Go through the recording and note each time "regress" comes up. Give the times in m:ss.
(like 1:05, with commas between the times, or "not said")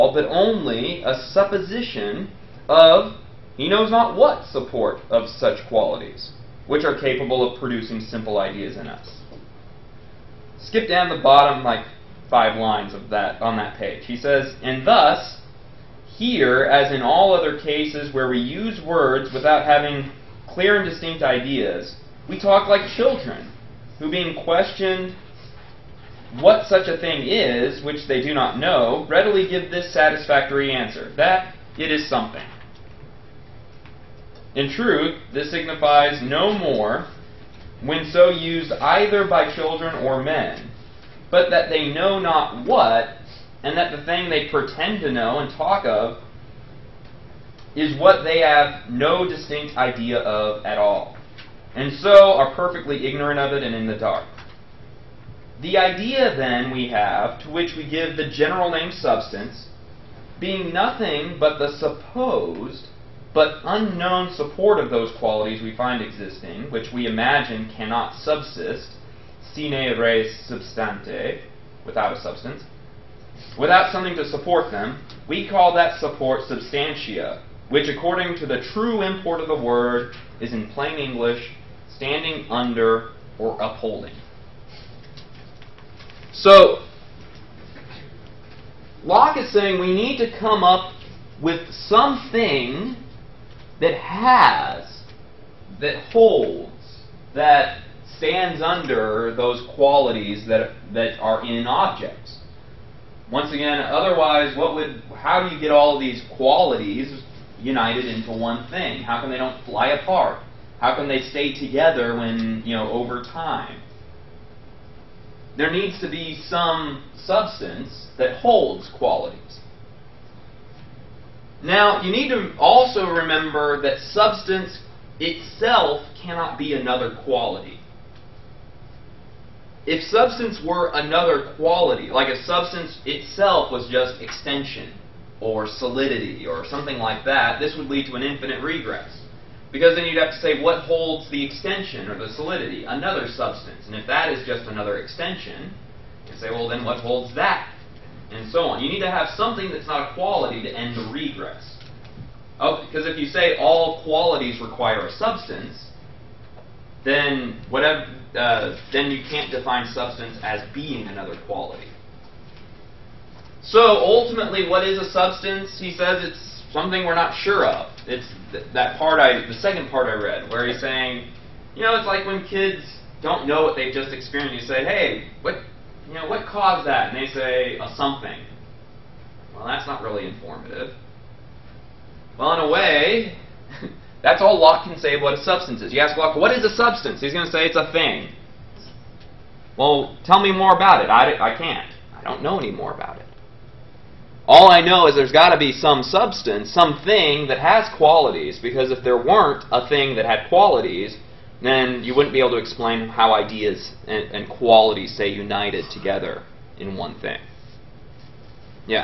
2:18, 2:31.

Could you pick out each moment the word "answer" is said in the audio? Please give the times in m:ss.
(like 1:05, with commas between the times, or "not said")
0:30.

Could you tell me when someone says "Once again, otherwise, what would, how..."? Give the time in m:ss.
1:43.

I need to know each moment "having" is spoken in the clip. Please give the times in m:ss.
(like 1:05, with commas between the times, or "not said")
0:19.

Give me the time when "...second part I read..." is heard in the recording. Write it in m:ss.
2:49.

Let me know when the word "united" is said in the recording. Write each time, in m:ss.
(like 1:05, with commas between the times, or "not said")
1:47, 3:25.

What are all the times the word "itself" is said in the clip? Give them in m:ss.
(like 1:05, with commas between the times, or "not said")
2:05, 2:13.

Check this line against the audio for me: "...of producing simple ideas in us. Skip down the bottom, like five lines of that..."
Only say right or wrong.
right.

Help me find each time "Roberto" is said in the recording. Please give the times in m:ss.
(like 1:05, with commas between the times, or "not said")
not said.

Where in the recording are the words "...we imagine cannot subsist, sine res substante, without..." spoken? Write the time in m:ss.
1:06.